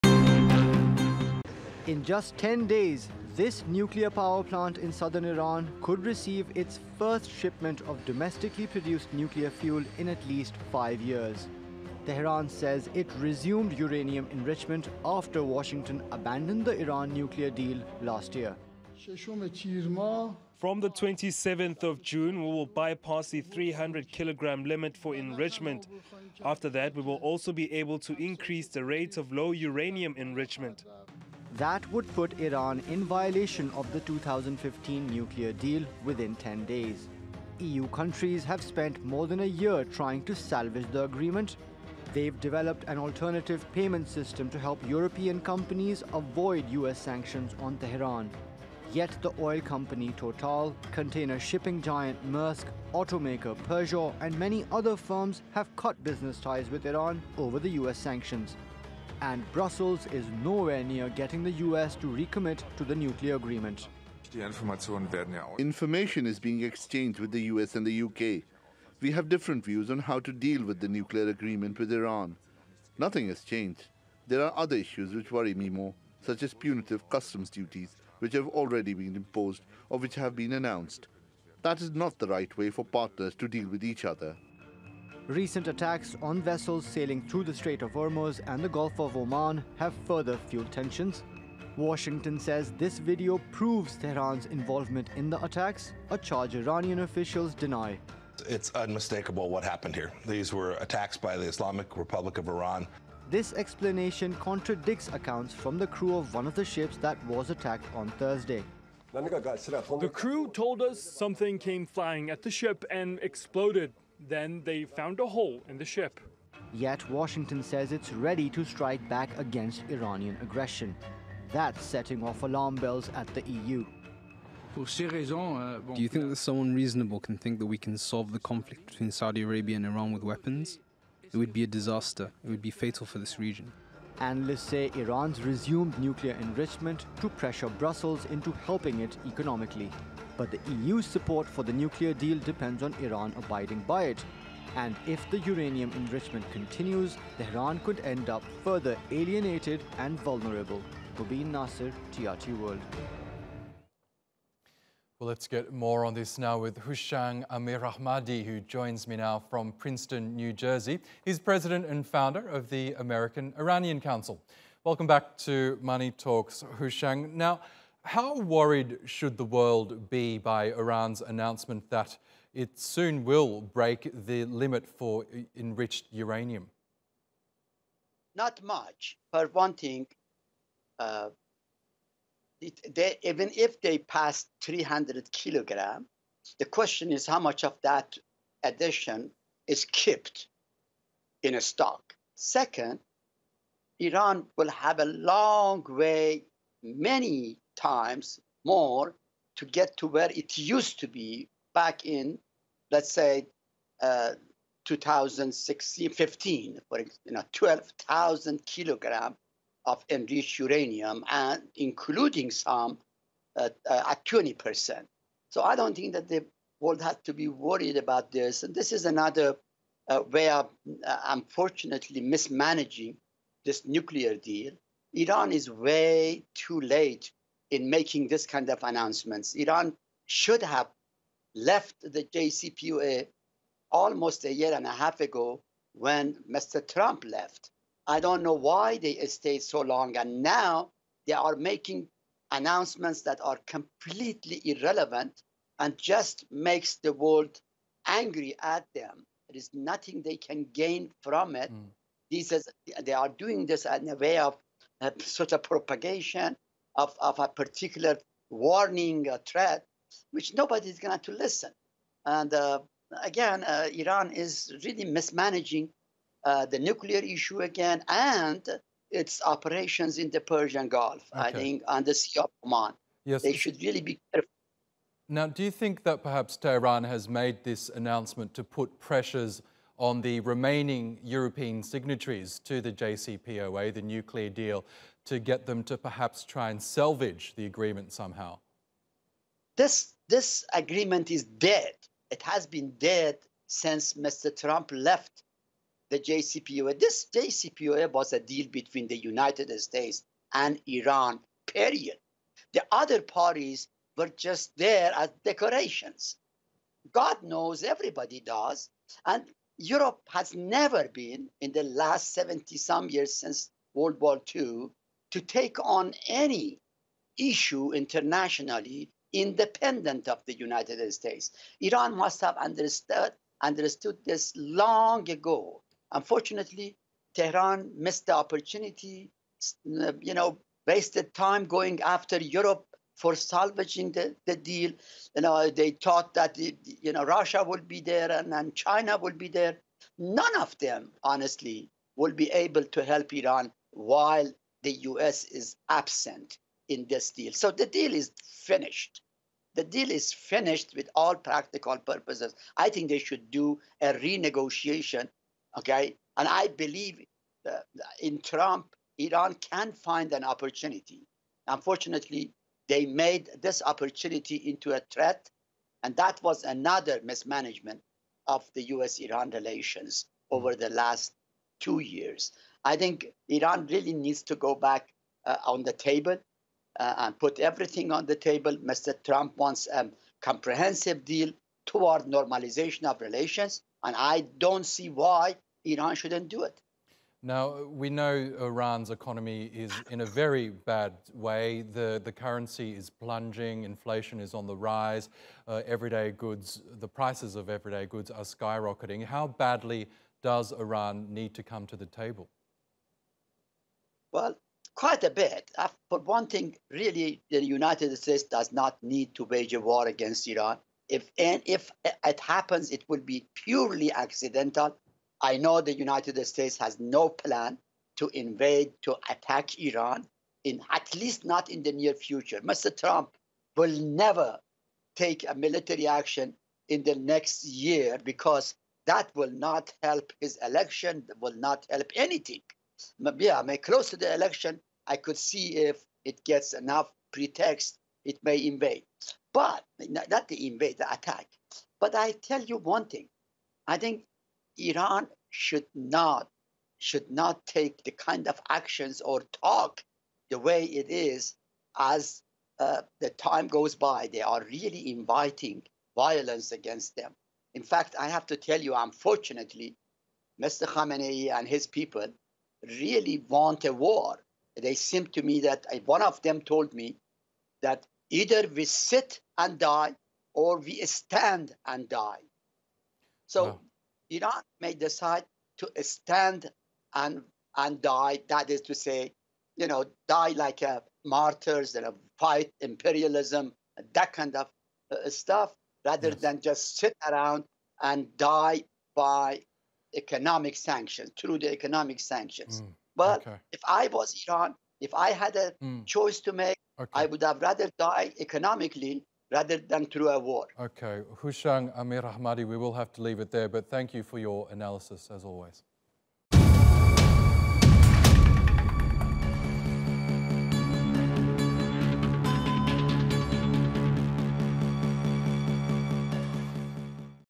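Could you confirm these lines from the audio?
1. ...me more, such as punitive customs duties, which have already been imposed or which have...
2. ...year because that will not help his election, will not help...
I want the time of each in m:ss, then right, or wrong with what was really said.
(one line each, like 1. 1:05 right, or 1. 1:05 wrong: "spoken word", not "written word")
1. 1:15 right
2. 7:07 right.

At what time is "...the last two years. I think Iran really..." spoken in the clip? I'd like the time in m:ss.
6:10.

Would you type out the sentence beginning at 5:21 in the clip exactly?
Iran must have understood, understood this long ago.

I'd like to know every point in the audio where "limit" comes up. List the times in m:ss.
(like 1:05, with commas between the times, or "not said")
0:24, 2:54.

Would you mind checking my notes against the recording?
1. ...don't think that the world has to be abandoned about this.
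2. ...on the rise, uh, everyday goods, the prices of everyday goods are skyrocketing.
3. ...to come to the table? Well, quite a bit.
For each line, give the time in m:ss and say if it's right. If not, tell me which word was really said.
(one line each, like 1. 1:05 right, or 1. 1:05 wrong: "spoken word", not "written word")
1. 3:35 wrong: "worried", not "abandoned"
2. 6:34 right
3. 6:41 right.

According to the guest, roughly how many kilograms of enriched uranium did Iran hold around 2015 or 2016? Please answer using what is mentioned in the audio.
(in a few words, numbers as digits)
12,000.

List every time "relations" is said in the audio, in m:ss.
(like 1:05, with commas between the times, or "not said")
6:09, 6:23.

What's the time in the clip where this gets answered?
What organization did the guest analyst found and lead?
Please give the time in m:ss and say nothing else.
2:42.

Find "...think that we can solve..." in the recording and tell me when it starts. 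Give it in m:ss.
2:07.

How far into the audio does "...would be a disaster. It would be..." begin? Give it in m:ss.
2:11.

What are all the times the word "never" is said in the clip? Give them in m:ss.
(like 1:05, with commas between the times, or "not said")
5:10, 7:03.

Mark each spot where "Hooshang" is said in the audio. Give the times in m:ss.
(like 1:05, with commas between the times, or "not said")
2:36, 2:46, 8:21.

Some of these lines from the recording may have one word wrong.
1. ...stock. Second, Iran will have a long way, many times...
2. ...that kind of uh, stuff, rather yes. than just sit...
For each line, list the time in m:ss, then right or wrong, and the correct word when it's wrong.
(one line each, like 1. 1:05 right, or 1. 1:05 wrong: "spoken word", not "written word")
1. 3:11 right
2. 8:04 right.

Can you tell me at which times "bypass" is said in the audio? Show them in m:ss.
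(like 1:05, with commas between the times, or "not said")
0:22.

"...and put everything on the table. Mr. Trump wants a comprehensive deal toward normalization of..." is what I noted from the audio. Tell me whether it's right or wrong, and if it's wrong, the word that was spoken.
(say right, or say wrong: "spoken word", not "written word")
right.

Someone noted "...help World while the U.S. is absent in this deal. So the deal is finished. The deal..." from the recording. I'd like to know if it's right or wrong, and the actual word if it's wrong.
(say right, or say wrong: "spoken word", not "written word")
wrong: "Iran", not "World".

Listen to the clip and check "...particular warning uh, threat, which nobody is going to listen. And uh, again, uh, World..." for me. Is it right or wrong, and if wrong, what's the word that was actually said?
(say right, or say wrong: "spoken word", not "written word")
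wrong: "Iran", not "World".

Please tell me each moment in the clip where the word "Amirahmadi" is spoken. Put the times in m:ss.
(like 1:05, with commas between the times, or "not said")
2:37, 8:21.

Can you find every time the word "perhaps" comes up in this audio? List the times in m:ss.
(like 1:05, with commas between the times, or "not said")
4:36, 4:45.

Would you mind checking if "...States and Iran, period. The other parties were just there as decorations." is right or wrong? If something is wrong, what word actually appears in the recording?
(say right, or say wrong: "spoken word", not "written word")
right.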